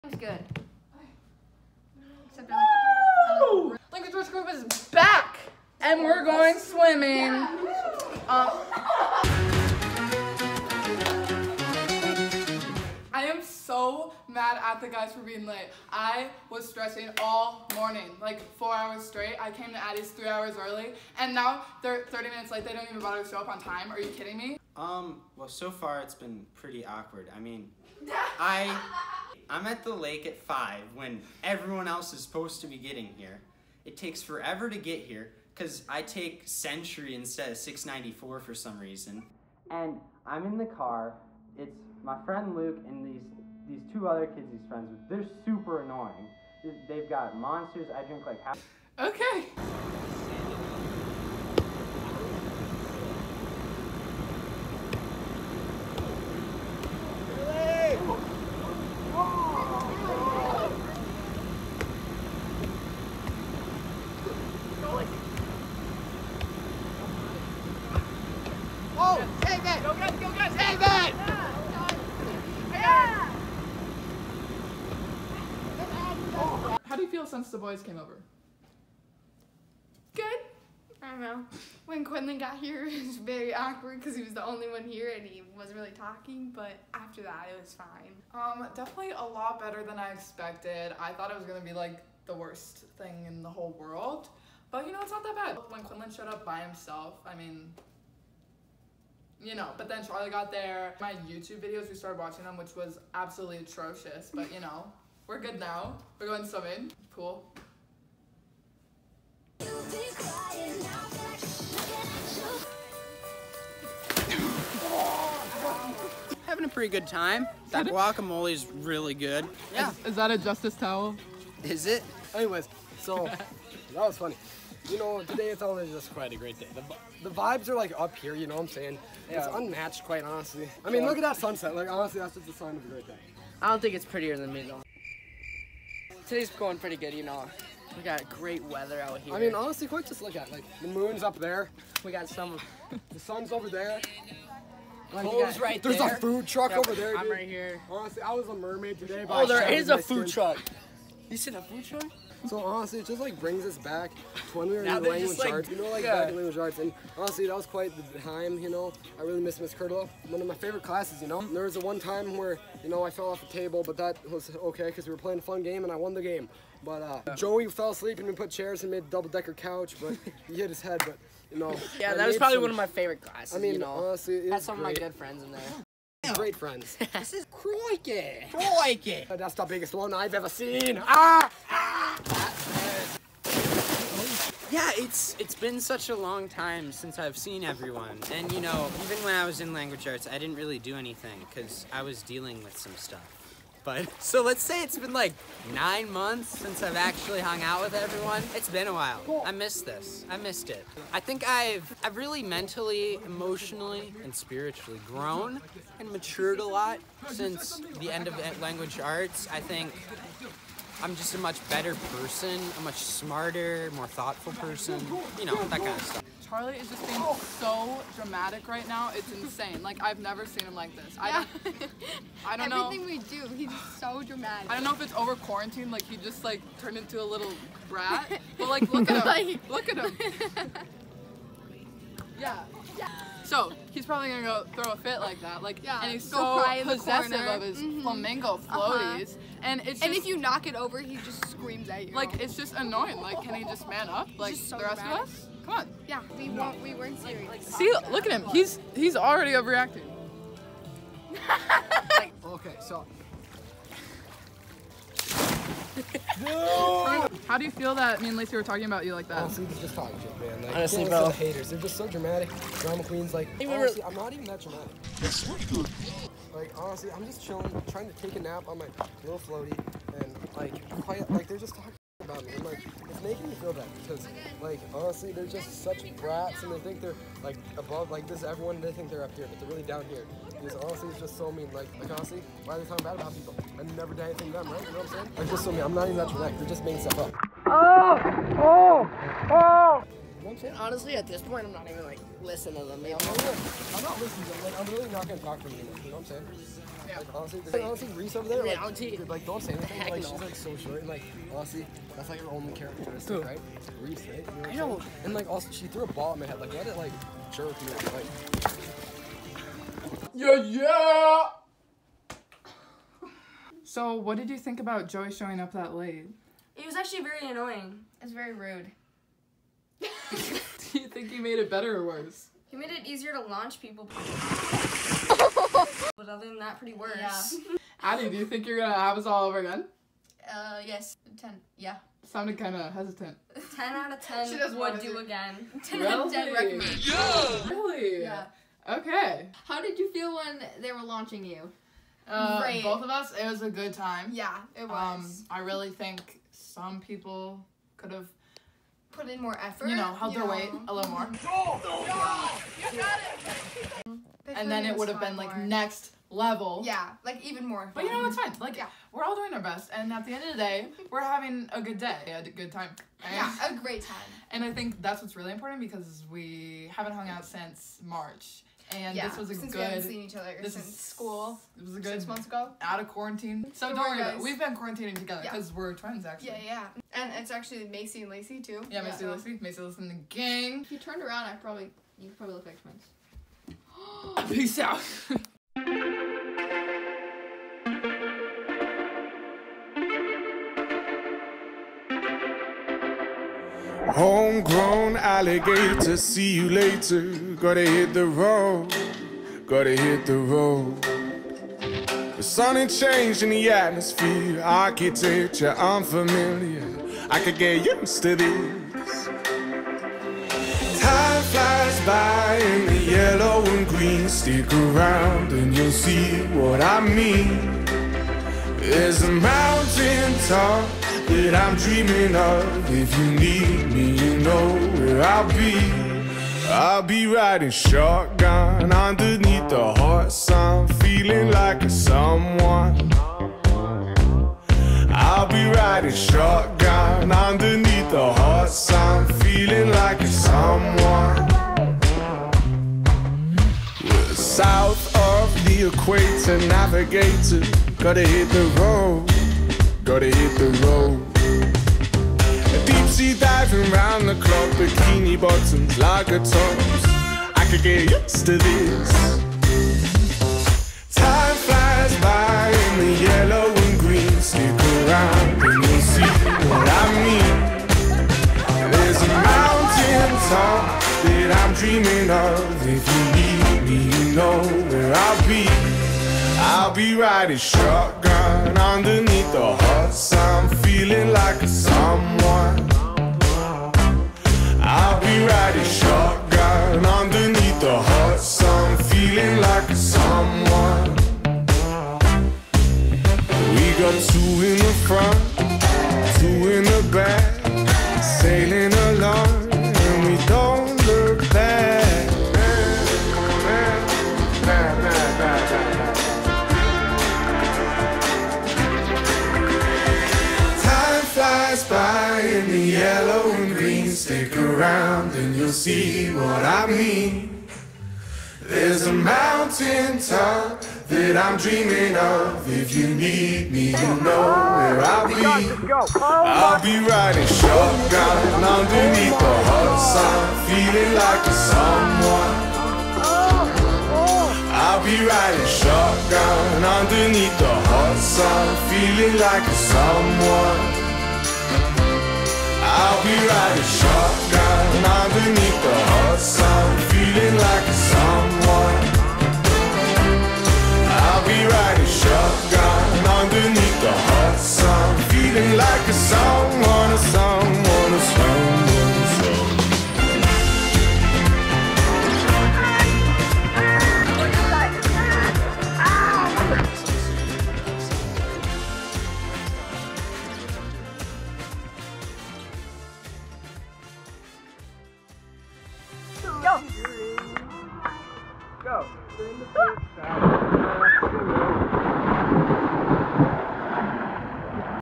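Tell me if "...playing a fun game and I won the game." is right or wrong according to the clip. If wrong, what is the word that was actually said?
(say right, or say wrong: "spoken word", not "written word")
right.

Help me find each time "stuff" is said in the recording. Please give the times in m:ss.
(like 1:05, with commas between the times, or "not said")
3:12, 3:36, 4:47.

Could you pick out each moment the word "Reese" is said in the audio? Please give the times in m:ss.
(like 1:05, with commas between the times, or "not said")
4:58, 5:04.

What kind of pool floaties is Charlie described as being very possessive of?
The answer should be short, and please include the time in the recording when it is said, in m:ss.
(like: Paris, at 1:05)
Flamingo, at 3:58.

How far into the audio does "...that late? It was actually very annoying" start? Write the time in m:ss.
5:15.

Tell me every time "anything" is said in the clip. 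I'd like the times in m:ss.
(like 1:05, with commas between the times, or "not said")
3:10, 4:44, 4:59.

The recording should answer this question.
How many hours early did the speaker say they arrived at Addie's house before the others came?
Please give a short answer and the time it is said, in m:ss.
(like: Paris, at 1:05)
3, at 0:20.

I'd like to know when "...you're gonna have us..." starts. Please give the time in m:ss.
5:28.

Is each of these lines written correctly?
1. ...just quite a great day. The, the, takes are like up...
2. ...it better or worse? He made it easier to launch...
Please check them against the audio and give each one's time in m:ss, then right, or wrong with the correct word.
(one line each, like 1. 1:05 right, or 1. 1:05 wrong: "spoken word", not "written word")
1. 2:05 wrong: "vibes", not "takes"
2. 5:21 right.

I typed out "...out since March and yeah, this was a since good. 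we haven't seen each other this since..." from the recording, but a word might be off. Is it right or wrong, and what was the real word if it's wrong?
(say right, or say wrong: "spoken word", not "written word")
right.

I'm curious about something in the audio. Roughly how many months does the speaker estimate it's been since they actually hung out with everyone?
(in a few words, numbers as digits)
9.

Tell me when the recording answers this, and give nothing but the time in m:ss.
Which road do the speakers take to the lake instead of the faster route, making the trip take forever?
0:36.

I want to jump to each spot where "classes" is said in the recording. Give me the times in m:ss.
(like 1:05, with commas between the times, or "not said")
2:40, 2:53.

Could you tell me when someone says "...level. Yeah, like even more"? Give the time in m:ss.
5:56.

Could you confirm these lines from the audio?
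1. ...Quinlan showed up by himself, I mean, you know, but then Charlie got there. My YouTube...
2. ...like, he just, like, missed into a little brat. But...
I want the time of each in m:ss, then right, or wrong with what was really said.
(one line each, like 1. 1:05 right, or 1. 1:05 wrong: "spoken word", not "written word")
1. 1:35 right
2. 3:45 wrong: "turned", not "missed".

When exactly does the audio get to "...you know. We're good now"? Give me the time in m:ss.
1:44.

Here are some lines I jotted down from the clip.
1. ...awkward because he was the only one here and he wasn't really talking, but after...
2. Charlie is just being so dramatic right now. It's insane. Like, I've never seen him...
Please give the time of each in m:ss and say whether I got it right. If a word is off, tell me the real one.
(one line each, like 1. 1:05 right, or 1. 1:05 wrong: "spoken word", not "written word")
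1. 1:23 right
2. 3:36 right.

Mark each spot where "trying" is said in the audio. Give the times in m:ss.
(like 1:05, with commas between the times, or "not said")
4:27.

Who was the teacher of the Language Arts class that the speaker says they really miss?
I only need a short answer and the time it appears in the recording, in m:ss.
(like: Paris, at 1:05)
Miss Curtle, at 2:39.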